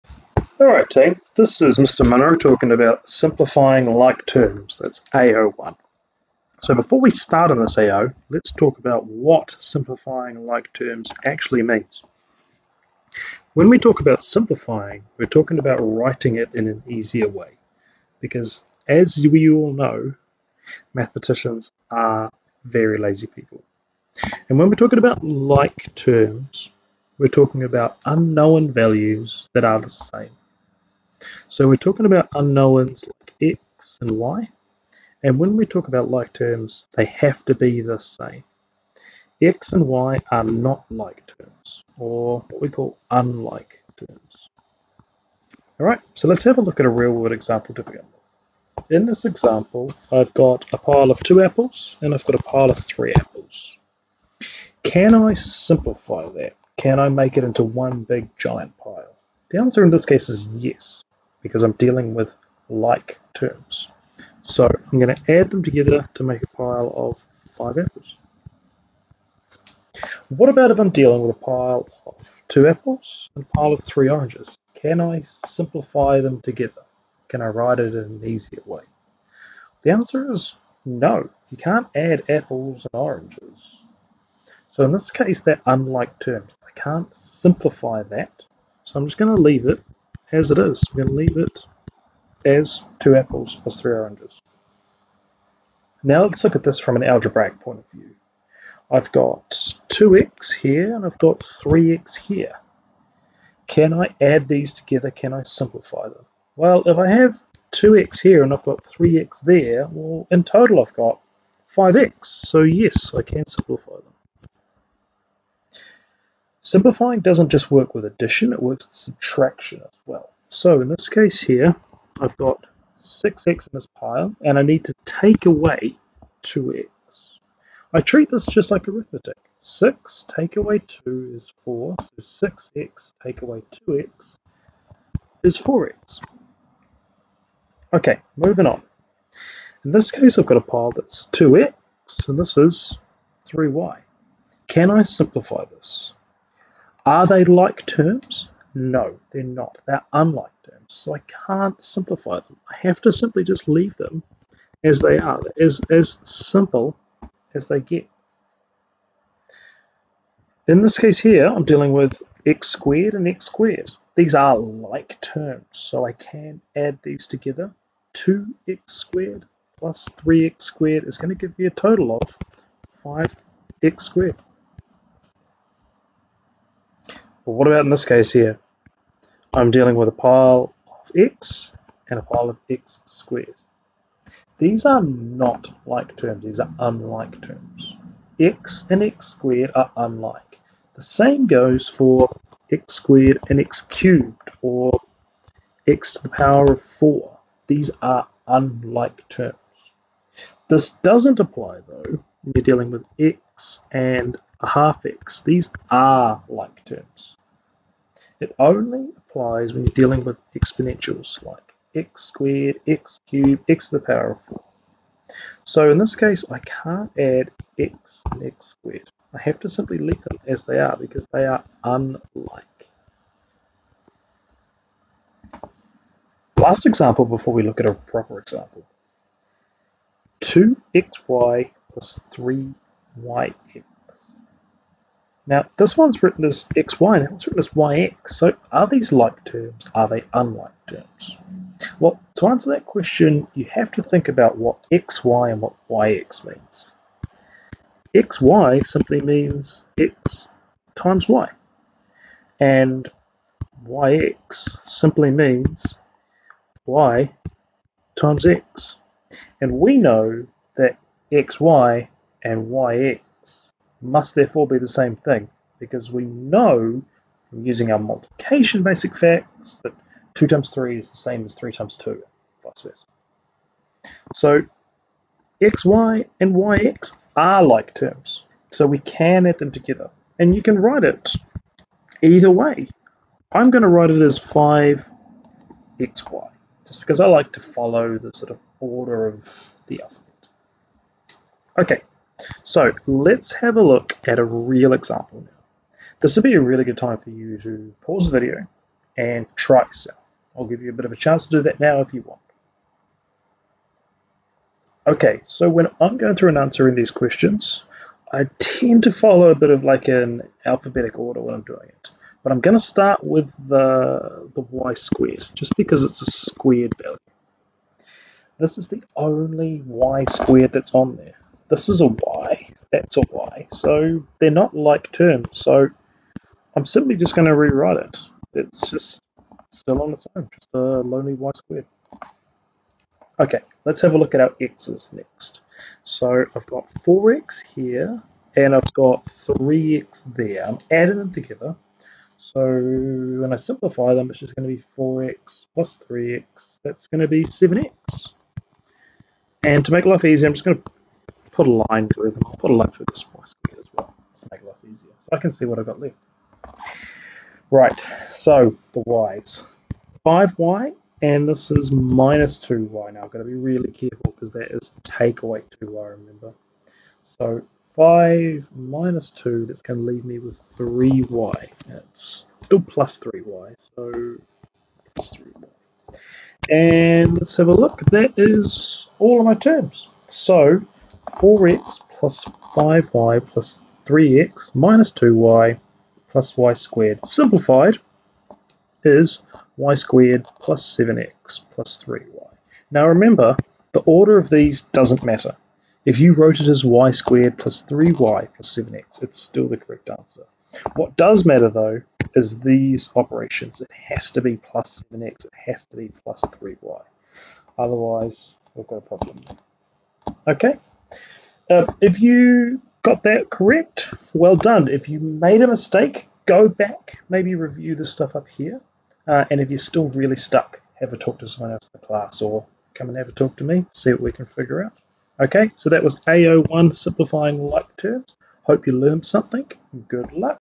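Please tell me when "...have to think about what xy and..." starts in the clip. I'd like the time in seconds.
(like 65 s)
243 s.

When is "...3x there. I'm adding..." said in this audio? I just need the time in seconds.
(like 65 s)
339 s.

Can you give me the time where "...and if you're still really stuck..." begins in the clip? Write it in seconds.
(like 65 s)
419 s.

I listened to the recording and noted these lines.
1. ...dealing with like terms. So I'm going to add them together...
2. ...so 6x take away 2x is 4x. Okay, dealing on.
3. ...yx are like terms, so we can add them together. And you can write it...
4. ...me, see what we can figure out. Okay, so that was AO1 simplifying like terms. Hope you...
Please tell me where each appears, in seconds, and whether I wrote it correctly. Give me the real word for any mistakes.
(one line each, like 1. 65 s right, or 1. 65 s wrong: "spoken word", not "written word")
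1. 61 s right
2. 132 s wrong: "moving", not "dealing"
3. 276 s right
4. 423 s right.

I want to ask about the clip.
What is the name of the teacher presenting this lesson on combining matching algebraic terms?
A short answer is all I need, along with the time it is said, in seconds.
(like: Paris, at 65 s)
Mr. Munro, at 1 s.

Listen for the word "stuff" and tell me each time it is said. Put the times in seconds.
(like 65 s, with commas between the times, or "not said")
418 s.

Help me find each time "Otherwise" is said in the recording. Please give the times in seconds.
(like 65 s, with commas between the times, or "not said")
407 s.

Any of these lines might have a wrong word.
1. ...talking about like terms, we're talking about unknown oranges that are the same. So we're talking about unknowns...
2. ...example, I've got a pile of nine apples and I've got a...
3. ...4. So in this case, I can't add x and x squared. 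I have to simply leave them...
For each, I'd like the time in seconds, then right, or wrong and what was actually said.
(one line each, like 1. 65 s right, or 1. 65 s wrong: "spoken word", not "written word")
1. 24 s wrong: "values", not "oranges"
2. 49 s wrong: "two", not "nine"
3. 214 s right.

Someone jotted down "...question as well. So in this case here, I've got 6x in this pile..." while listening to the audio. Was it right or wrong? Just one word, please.
wrong.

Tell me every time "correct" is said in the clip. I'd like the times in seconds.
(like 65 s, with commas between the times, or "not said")
399 s, 413 s.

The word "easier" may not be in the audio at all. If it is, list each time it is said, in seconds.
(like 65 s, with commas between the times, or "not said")
16 s, 78 s, 354 s.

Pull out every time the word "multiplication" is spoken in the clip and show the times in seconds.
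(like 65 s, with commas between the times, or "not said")
267 s.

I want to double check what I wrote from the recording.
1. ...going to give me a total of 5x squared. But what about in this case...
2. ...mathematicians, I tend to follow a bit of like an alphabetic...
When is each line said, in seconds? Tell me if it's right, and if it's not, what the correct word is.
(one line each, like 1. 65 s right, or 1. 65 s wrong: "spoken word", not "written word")
1. 171 s right
2. 307 s wrong: "questions", not "mathematicians".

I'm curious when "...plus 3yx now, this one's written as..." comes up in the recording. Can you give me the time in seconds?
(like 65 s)
231 s.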